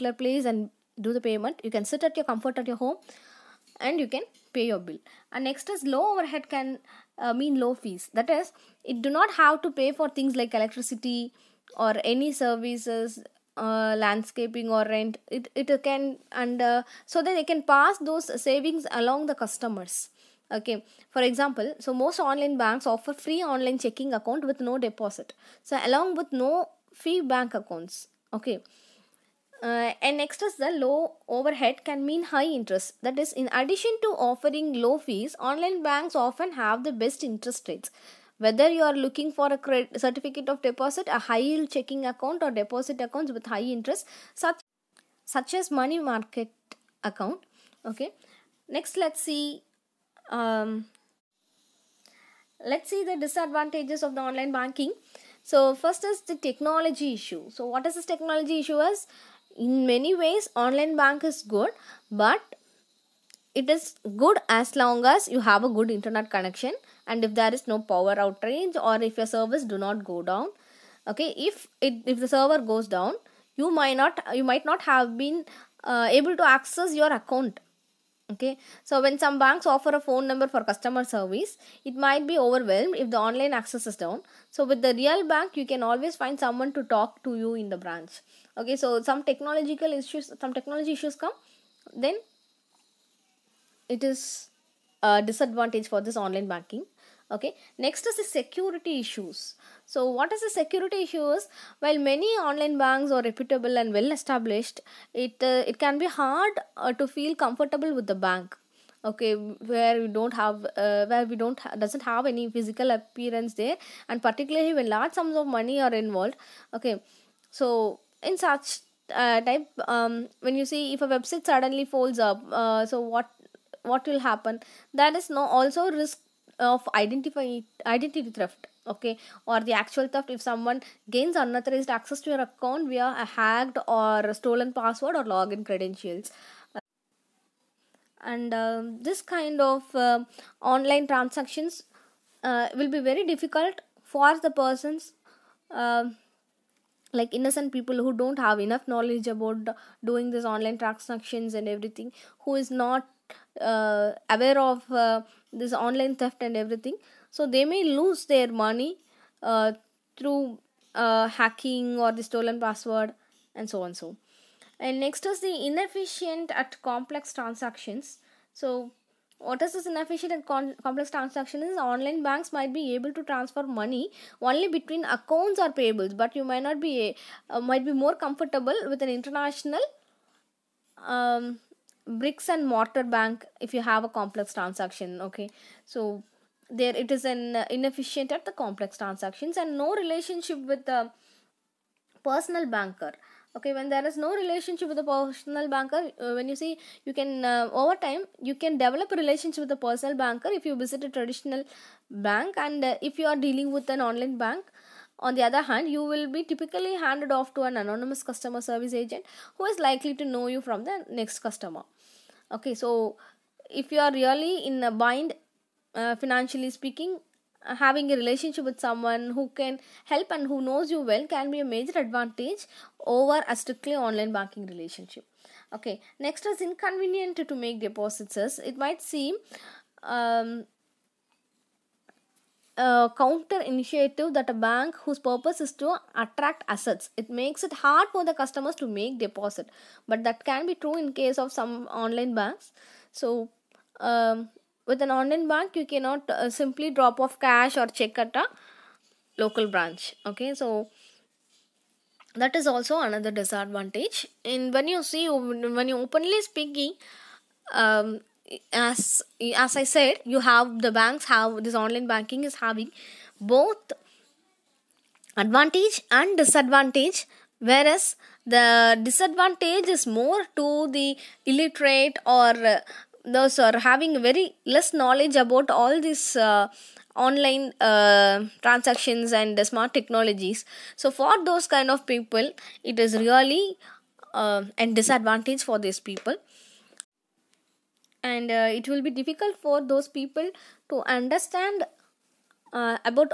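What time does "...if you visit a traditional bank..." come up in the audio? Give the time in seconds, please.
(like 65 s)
200 s.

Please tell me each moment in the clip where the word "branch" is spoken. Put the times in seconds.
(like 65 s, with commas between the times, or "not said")
87 s, 249 s.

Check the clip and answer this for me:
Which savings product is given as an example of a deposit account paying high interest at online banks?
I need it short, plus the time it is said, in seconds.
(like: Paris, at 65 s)
Money market account, at 45 s.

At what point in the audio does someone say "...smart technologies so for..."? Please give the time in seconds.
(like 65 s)
279 s.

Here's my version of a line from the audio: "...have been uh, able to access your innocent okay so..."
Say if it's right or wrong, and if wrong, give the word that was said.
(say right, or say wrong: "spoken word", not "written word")
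wrong: "account", not "innocent".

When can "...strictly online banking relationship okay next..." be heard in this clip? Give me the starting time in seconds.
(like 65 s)
223 s.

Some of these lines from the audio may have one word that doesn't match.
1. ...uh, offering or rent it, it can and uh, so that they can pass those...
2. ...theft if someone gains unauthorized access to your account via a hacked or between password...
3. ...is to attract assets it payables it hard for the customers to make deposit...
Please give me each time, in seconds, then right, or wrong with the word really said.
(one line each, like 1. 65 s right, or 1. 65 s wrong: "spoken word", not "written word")
1. 13 s wrong: "landscaping", not "offering"
2. 130 s wrong: "stolen", not "between"
3. 235 s wrong: "makes", not "payables".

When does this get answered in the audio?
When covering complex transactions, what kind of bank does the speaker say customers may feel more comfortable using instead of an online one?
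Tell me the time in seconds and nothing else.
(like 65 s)
182 s.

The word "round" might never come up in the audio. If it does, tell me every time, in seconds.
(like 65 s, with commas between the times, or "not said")
not said.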